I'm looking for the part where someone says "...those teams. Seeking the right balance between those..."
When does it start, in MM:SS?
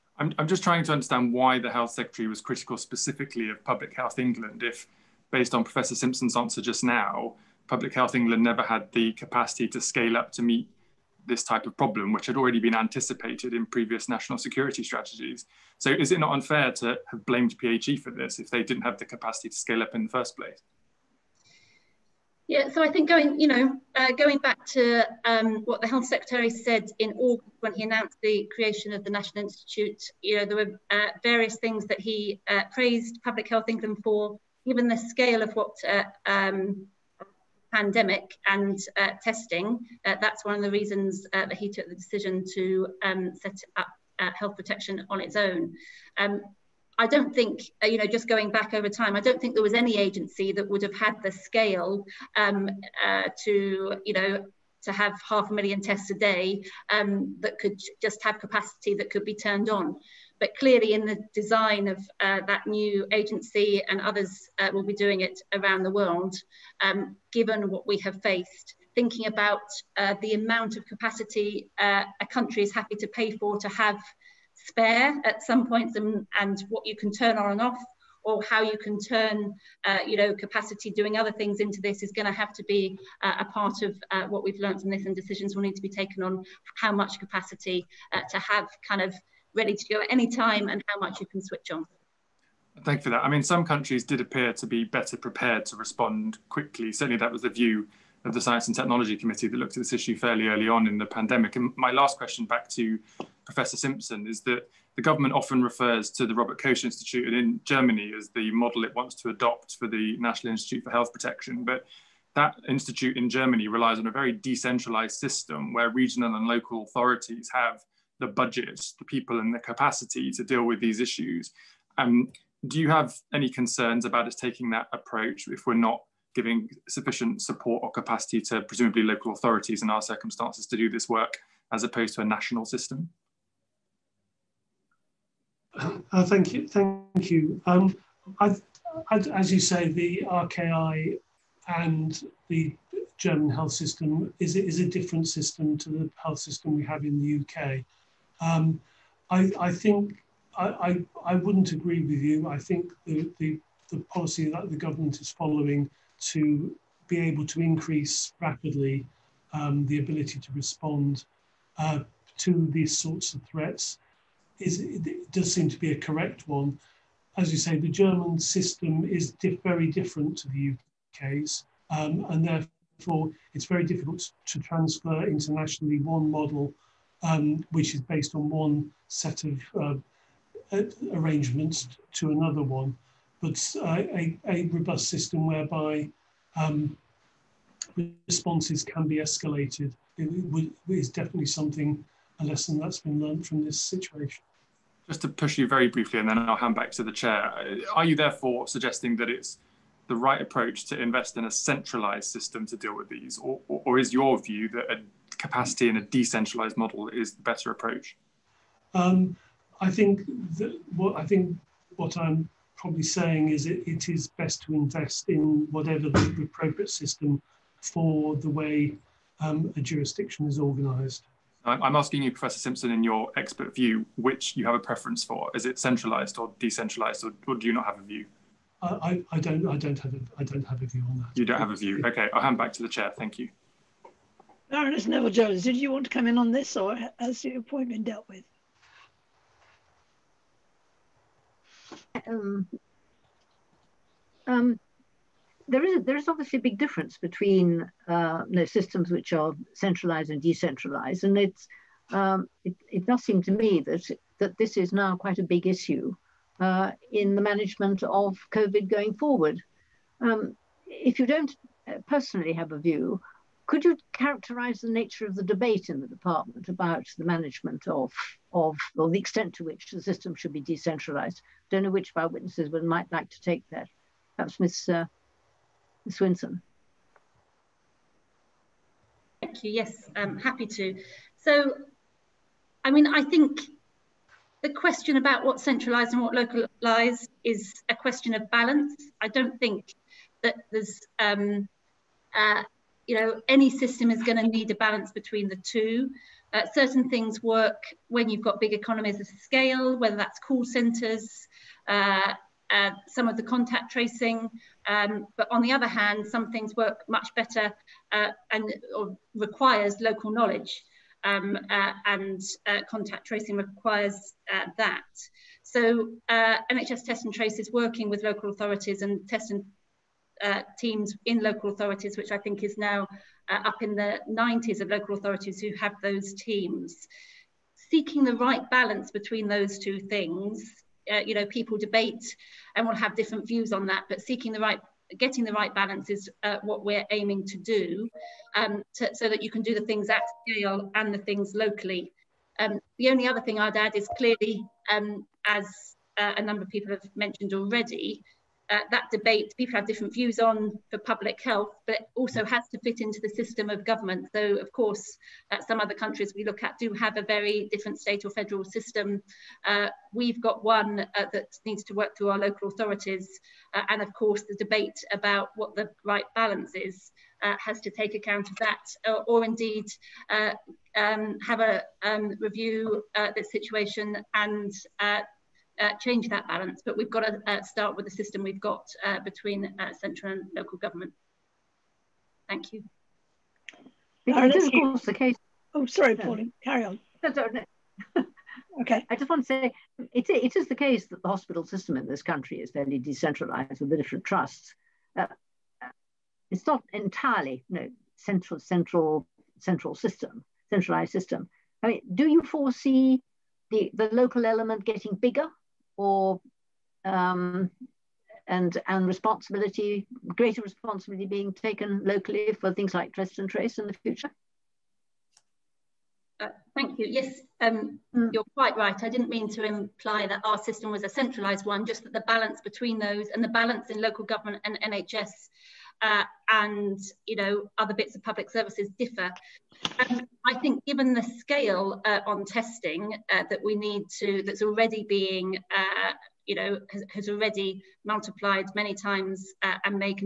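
05:26.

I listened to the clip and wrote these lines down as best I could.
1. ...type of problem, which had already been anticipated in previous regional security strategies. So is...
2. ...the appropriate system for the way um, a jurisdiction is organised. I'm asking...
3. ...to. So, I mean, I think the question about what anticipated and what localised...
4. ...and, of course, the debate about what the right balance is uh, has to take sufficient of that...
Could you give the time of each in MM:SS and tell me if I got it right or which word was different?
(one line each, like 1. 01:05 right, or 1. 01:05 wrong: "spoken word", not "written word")
1. 00:11 wrong: "national", not "regional"
2. 03:36 right
3. 04:40 wrong: "centralised", not "anticipated"
4. 06:03 wrong: "account", not "sufficient".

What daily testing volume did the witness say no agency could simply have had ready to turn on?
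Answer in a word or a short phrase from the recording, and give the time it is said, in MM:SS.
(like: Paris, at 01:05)
half a million tests a day, at 00:55.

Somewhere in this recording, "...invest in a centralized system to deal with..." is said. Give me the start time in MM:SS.
03:21.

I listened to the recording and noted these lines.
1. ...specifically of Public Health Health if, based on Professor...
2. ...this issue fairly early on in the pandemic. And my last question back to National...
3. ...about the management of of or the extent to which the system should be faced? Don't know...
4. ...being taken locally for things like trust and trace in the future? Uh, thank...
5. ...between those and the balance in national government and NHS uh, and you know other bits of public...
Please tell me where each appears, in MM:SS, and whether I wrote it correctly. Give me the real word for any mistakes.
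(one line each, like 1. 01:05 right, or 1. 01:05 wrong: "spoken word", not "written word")
1. 00:02 wrong: "England", not "Health"
2. 01:39 wrong: "Professor", not "National"
3. 04:26 wrong: "decentralized", not "faced"
4. 06:51 right
5. 07:02 wrong: "local", not "national".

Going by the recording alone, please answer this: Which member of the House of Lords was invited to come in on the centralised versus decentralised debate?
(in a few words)
Baroness Neville Jones.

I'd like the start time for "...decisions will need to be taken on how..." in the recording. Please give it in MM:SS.
01:25.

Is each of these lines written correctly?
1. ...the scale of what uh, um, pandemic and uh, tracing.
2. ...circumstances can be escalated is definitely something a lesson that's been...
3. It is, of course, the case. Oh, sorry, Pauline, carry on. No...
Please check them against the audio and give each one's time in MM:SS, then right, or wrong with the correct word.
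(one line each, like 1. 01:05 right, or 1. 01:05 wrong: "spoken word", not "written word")
1. 00:34 wrong: "testing", not "tracing"
2. 03:08 wrong: "responses", not "circumstances"
3. 06:24 right.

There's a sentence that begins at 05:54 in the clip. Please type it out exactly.
So, of course, uh, some other countries we look at do have a very different state or federal system.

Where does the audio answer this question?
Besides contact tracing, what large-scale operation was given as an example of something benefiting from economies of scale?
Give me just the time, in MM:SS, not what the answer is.
05:00.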